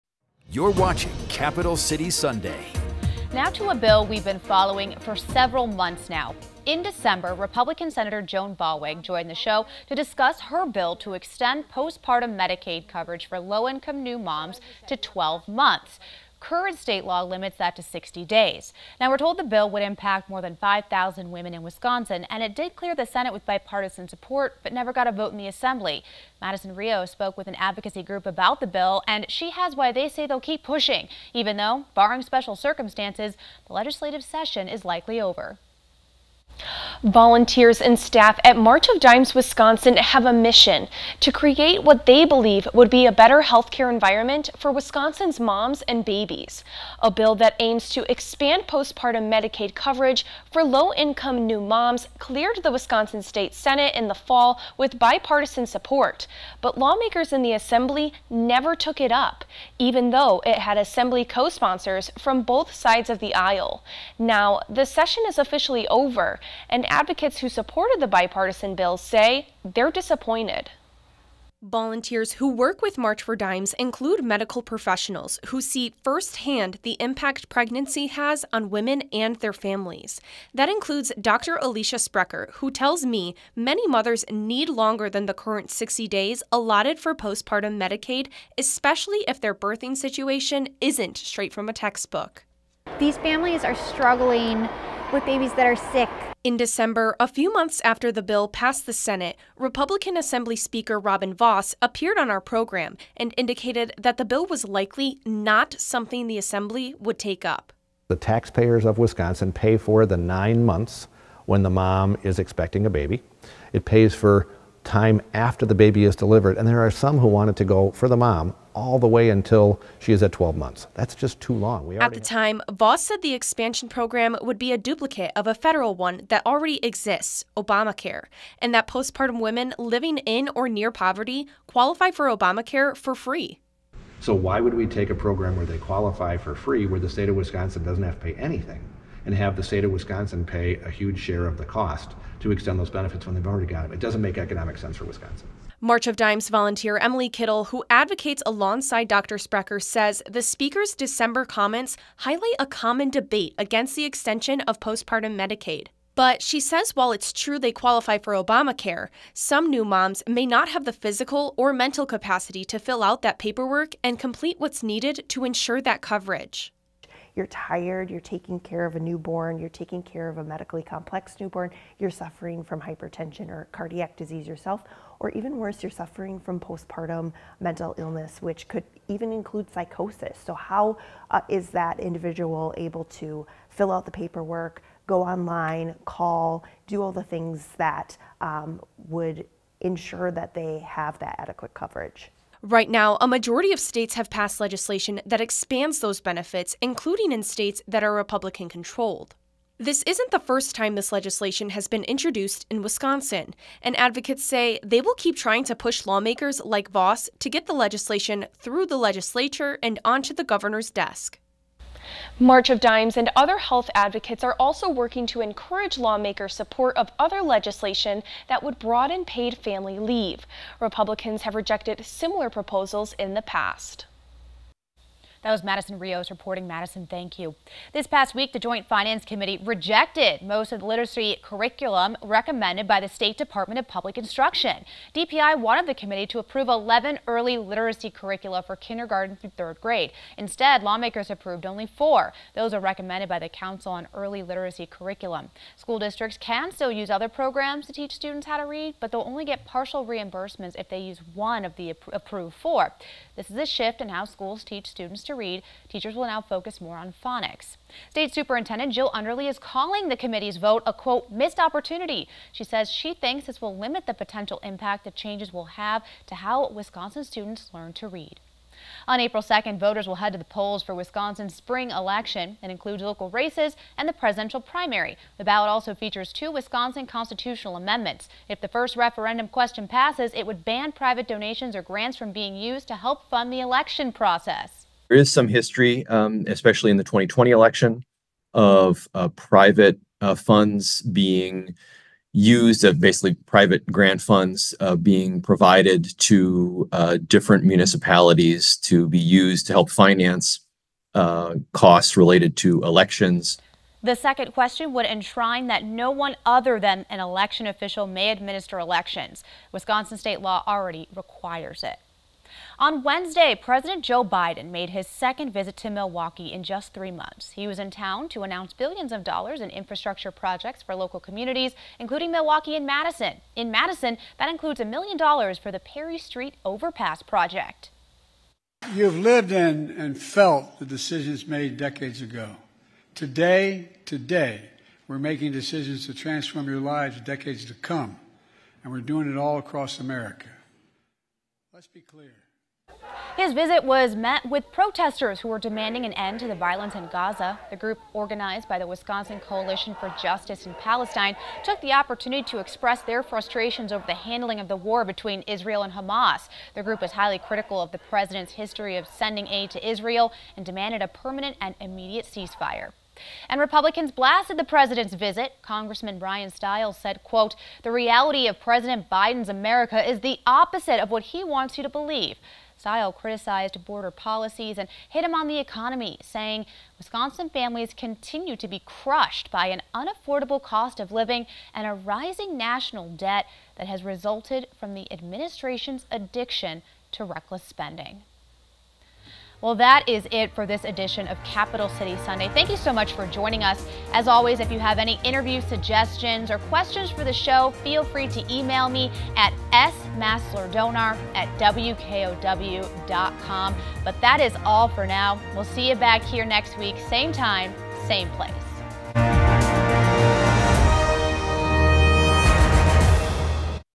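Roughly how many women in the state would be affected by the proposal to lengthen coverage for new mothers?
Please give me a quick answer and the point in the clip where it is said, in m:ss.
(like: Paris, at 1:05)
more than 5,000, at 0:20.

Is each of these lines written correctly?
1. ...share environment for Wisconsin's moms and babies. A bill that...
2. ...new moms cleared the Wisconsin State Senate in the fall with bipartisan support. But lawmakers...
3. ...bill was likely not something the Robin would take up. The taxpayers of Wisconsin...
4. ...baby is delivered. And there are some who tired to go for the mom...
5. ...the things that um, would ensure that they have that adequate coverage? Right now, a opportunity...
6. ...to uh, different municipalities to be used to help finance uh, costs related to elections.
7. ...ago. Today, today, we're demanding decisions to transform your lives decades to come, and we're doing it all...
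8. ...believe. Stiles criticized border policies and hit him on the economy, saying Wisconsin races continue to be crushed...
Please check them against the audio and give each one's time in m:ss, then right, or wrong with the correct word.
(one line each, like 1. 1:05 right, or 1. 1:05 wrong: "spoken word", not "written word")
1. 0:43 wrong: "healthcare", not "share"
2. 0:51 right
3. 1:44 wrong: "Assembly", not "Robin"
4. 1:55 wrong: "wanted", not "tired"
5. 3:07 wrong: "majority", not "opportunity"
6. 4:56 right
7. 5:32 wrong: "making", not "demanding"
8. 6:11 wrong: "families", not "races".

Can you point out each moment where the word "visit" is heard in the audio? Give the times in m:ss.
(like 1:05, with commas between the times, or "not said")
5:15, 5:43, 6:05.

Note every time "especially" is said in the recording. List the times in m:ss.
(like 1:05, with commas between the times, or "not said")
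1:28, 4:46.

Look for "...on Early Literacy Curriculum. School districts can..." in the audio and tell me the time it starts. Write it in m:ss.
4:03.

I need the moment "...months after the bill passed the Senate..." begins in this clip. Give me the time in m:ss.
1:37.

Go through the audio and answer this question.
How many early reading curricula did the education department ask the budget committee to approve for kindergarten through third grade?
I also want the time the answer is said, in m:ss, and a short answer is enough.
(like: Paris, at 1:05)
11, at 3:56.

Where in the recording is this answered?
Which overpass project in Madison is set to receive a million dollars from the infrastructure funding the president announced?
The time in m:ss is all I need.
5:25.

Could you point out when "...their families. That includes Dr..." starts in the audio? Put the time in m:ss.
1:19.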